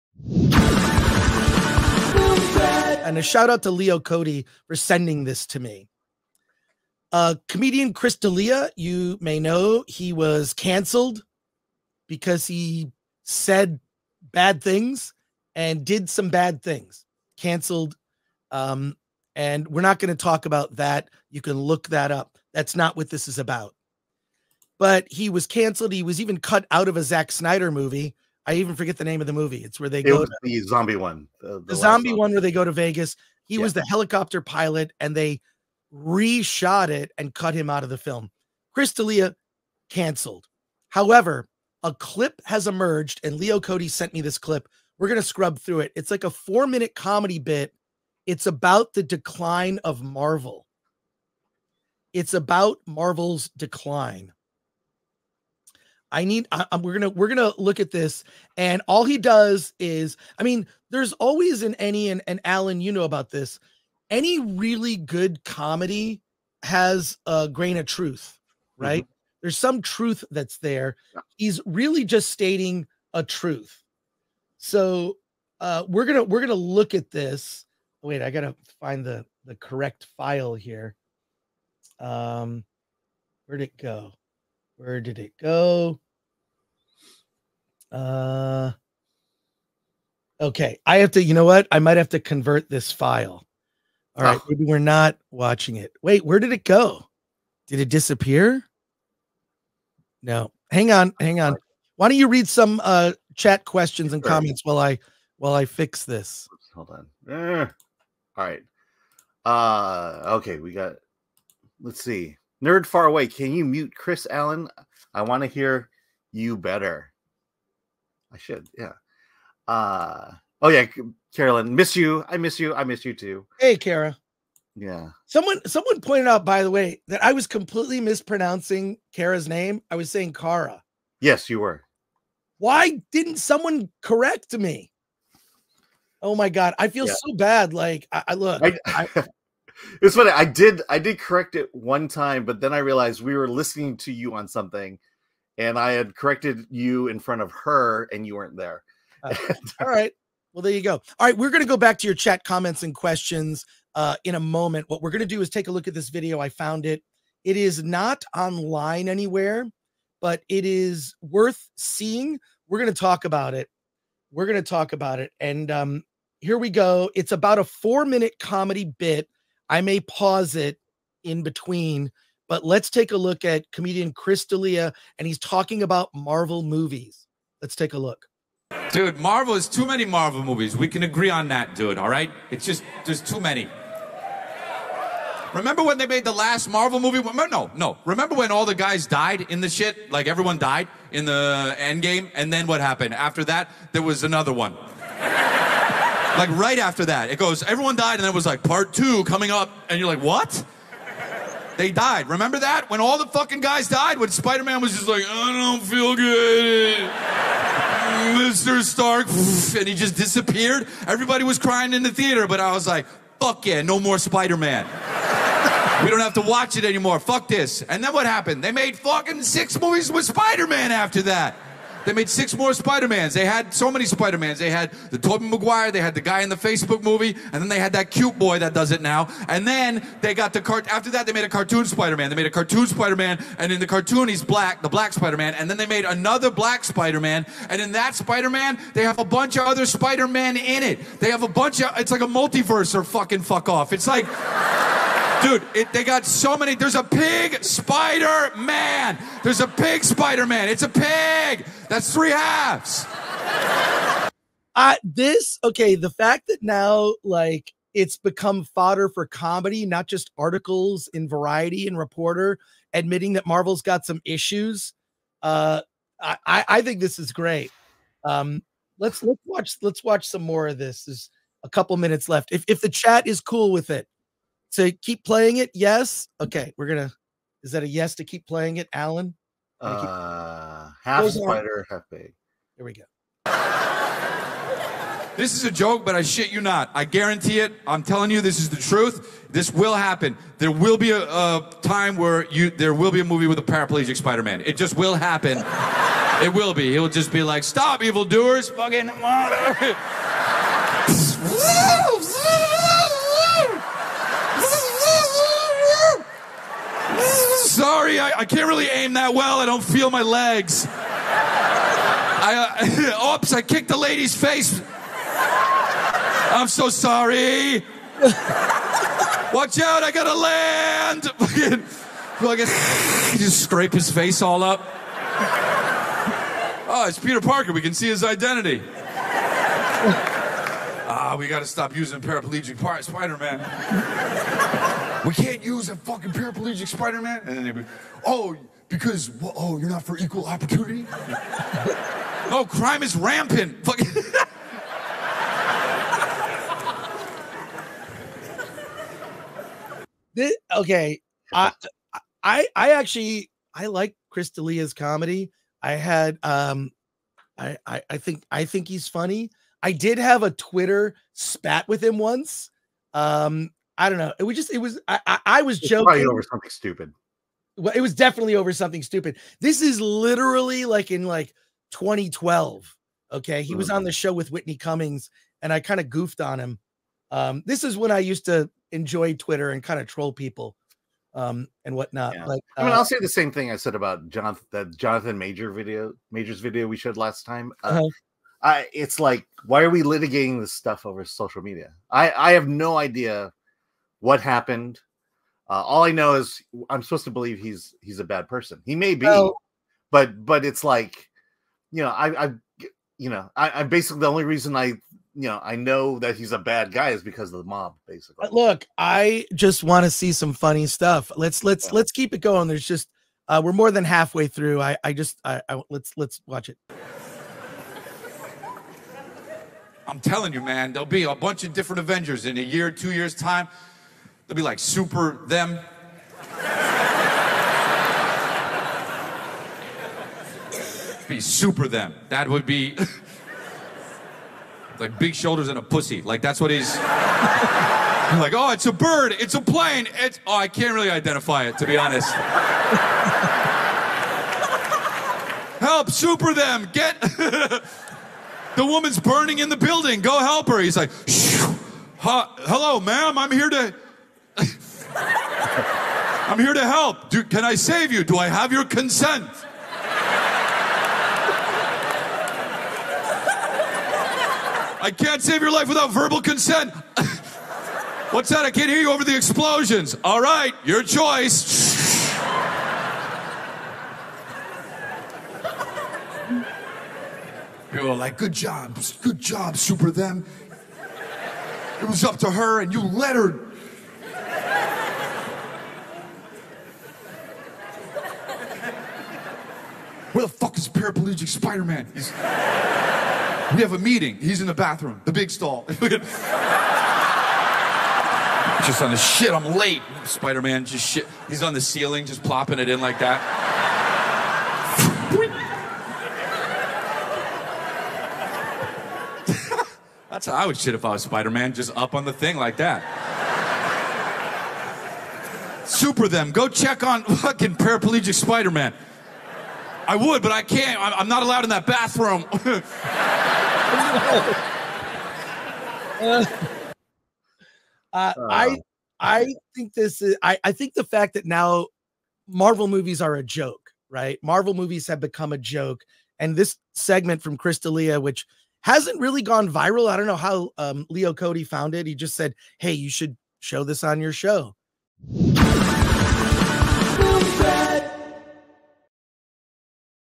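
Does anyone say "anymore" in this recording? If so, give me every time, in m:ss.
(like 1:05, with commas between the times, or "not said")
3:36.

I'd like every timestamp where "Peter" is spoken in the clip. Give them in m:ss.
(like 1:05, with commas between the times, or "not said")
5:27.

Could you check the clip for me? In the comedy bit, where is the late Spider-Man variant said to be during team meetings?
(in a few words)
The big stall.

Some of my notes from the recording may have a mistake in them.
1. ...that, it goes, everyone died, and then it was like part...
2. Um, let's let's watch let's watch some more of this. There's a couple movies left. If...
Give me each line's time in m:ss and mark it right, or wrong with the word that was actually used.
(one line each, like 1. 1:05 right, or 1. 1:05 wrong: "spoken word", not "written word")
1. 3:17 right
2. 4:28 wrong: "minutes", not "movies".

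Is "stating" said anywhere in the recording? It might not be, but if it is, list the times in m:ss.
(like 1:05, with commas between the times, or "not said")
1:12.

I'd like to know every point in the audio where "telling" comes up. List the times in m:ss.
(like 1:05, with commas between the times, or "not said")
4:48, 7:00.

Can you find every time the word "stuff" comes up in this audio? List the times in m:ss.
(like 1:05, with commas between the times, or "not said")
6:30, 6:50.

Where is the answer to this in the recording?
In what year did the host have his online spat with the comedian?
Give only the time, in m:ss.
6:11.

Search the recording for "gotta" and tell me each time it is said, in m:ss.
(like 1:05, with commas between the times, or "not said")
1:18, 5:20, 5:31.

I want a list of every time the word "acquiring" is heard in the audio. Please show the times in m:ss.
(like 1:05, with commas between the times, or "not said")
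not said.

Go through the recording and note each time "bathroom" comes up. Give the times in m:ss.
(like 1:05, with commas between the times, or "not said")
8:14, 8:41.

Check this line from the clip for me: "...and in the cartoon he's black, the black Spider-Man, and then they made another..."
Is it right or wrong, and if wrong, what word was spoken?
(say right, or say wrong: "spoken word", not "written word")
right.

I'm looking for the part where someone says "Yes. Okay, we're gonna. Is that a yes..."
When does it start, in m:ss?
4:35.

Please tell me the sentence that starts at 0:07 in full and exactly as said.
Uh, comedian Chris D'Elia, you may know, he was canceled because he said bad things and did some bad things.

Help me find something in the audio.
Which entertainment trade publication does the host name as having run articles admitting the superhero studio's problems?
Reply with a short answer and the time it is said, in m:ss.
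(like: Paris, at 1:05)
Variety, at 4:21.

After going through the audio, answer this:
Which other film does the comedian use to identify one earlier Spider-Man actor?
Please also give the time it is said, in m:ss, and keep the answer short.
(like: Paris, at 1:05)
The Facebook movie, at 3:46.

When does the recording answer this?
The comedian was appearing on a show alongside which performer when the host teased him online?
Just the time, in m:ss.
6:14.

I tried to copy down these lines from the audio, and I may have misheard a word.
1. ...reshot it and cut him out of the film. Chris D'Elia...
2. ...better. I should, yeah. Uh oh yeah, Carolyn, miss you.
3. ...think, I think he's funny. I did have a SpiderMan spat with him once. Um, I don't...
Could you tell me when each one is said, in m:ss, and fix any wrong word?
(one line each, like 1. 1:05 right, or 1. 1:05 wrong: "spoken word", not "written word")
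1. 0:35 right
2. 1:56 right
3. 5:58 wrong: "Twitter", not "SpiderMan".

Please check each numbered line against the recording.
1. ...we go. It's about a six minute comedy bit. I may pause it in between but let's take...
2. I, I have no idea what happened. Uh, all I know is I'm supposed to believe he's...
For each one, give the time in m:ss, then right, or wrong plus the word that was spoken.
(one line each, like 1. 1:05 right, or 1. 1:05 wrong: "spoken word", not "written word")
1. 2:46 wrong: "four", not "six"
2. 6:32 right.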